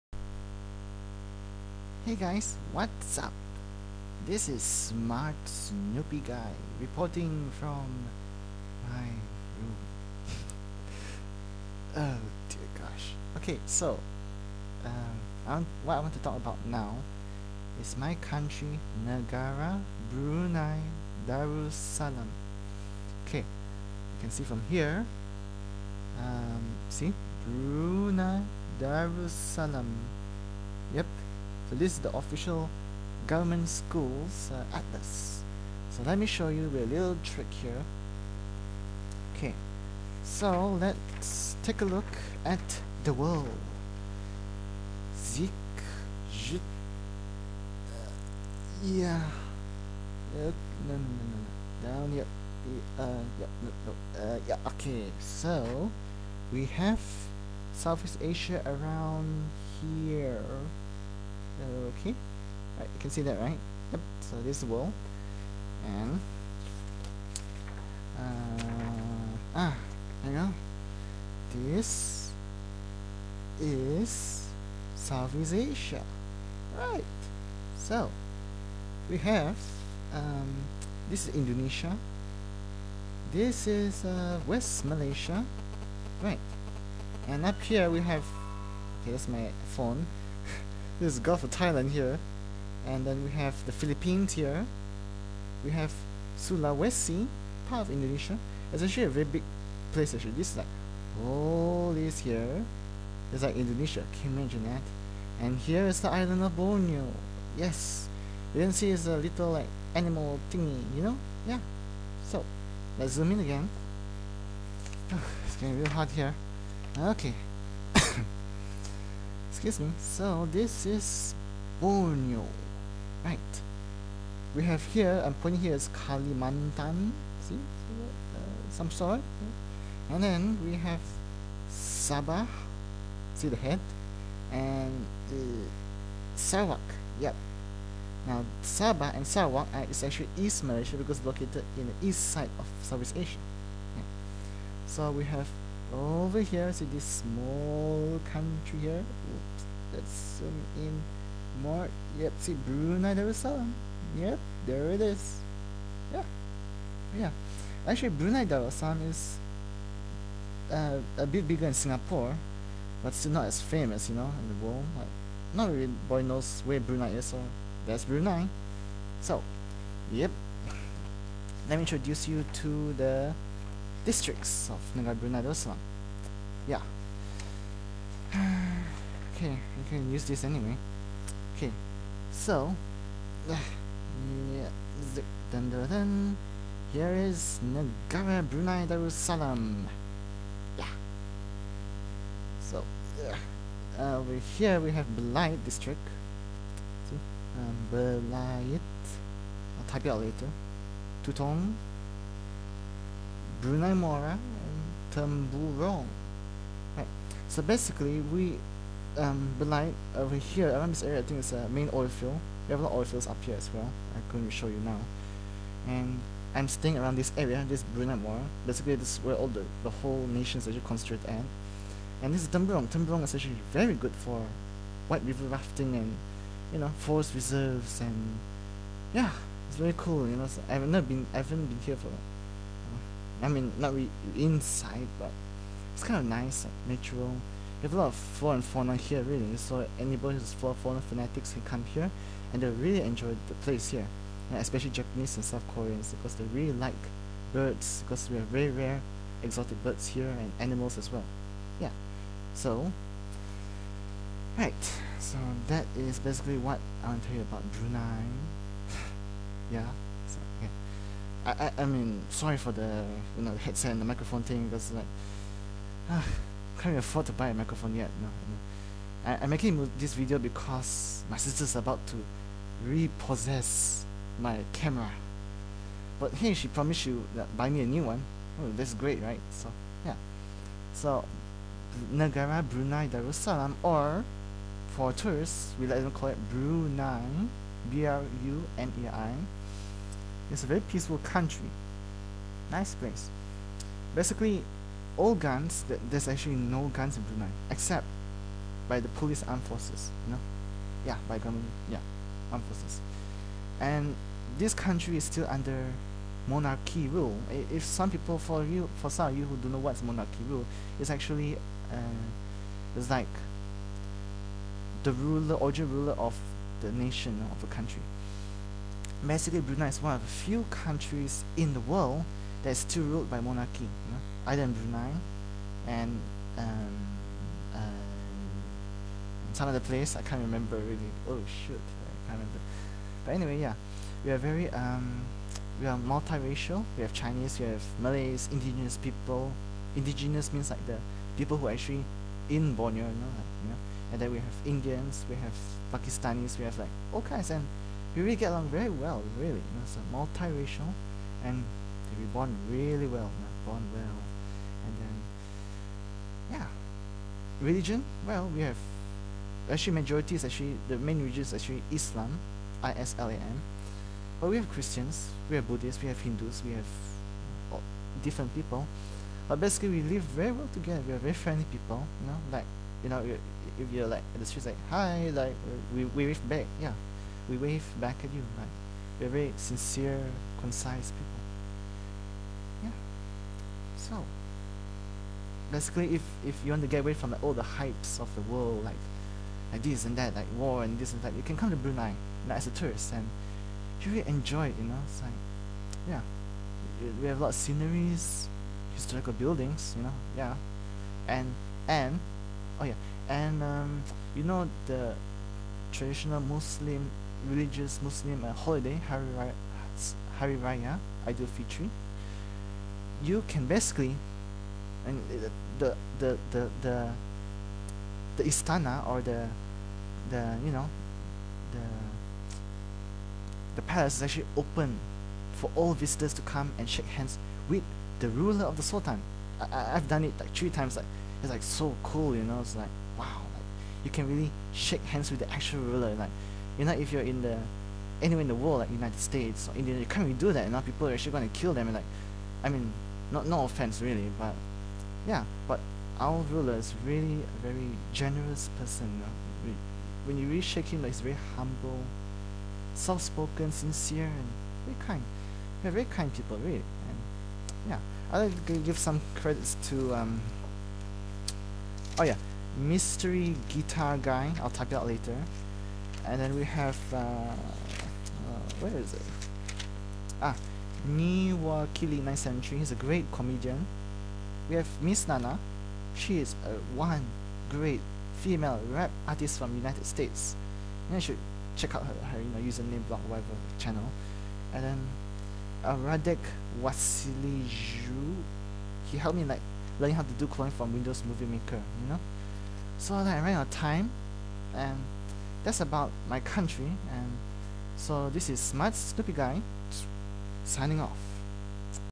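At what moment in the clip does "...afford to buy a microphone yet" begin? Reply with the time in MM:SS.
04:26.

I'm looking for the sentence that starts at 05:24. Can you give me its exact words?
Either in Brunei and um, uh, some other place, I can't remember really.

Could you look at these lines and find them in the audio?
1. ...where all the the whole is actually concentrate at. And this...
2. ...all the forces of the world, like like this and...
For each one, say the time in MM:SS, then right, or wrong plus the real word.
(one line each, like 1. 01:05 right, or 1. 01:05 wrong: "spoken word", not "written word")
1. 03:39 right
2. 06:27 wrong: "hypes", not "forces".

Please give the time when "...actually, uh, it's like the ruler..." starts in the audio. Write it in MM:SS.
05:11.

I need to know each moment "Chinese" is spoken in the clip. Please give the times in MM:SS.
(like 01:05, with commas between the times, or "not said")
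05:37.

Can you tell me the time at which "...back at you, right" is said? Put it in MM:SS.
06:17.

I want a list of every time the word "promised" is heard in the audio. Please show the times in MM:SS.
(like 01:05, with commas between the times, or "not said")
04:36.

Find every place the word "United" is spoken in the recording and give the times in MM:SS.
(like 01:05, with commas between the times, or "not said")
07:18, 07:59.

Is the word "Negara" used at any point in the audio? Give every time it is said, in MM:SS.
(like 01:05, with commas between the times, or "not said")
00:19, 03:07, 04:42.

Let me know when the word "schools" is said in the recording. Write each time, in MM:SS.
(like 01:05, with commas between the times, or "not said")
00:33.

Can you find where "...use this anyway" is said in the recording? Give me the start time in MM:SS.
03:00.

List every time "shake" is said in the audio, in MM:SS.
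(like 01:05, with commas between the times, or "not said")
07:06, 07:14, 07:30.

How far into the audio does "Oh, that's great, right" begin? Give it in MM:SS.
04:38.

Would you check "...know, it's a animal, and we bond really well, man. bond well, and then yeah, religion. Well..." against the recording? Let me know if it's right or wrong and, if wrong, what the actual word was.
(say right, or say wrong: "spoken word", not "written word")
wrong: "multiracial", not "animal".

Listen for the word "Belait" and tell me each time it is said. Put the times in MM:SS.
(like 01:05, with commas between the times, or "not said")
03:15, 03:29.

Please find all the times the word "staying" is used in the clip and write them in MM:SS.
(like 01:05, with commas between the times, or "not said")
03:36.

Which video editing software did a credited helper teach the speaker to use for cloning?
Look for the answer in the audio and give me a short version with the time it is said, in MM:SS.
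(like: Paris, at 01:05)
Windows Movie Maker, at 08:10.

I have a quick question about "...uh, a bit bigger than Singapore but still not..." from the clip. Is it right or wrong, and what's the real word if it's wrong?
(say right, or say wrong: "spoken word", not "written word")
right.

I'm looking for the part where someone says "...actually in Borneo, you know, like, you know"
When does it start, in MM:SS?
05:41.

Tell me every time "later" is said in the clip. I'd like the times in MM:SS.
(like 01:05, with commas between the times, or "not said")
03:20, 07:45.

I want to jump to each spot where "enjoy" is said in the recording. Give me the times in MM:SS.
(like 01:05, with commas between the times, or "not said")
04:03, 06:34.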